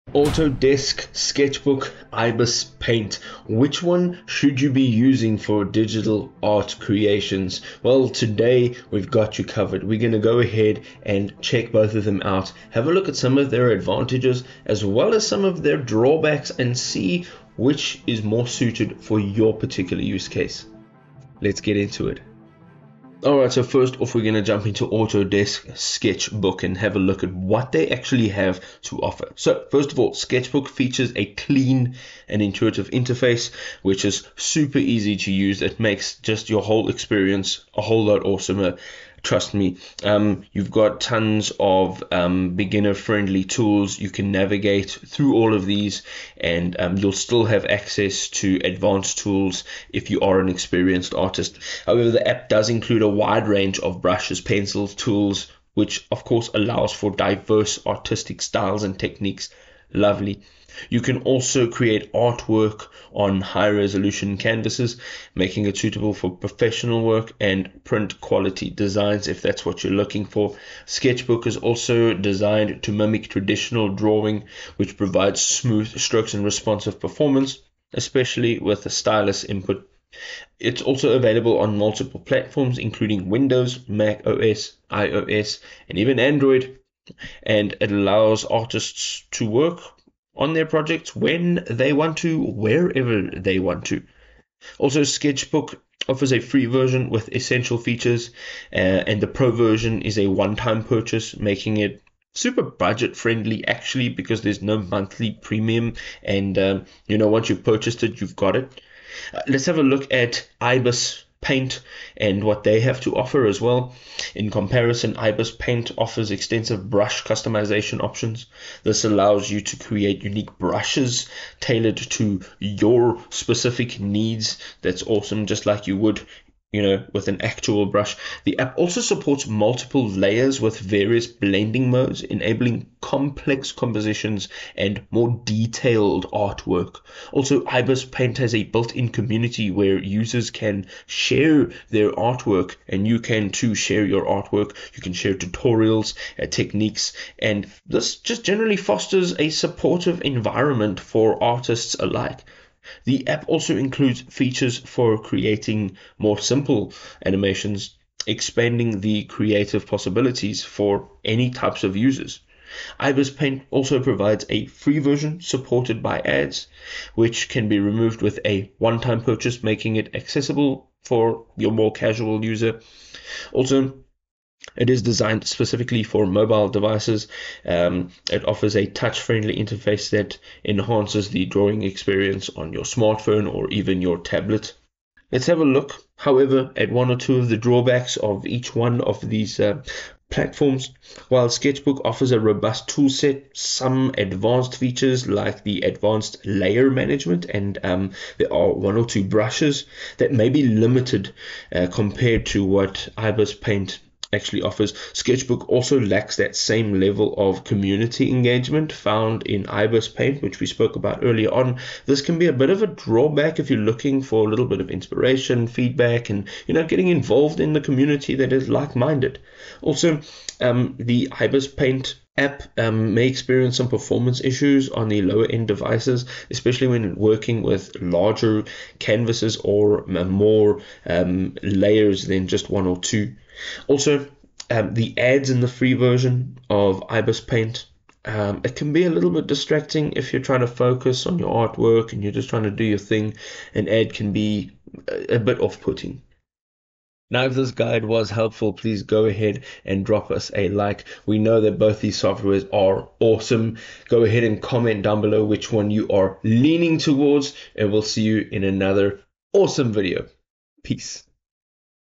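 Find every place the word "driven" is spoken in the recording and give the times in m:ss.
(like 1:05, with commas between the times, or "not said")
not said.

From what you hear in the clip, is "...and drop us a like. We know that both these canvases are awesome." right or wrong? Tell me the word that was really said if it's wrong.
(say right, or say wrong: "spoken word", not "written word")
wrong: "softwares", not "canvases".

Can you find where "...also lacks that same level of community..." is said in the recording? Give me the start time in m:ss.
3:25.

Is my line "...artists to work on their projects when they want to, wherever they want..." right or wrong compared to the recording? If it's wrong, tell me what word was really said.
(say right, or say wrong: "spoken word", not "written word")
right.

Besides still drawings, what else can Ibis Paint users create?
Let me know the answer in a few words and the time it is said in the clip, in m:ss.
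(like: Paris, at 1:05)
simple animations, at 2:36.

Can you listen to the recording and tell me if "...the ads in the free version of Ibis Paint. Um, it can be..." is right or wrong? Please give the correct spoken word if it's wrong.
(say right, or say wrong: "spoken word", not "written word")
right.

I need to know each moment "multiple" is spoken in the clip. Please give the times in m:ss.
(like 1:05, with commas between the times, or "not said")
1:21, 2:09.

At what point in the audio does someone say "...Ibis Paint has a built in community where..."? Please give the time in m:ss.
2:17.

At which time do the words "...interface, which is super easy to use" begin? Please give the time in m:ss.
0:32.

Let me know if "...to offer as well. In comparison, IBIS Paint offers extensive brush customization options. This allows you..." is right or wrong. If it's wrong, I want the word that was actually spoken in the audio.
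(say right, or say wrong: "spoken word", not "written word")
right.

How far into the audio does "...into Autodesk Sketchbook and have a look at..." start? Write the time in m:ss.
0:24.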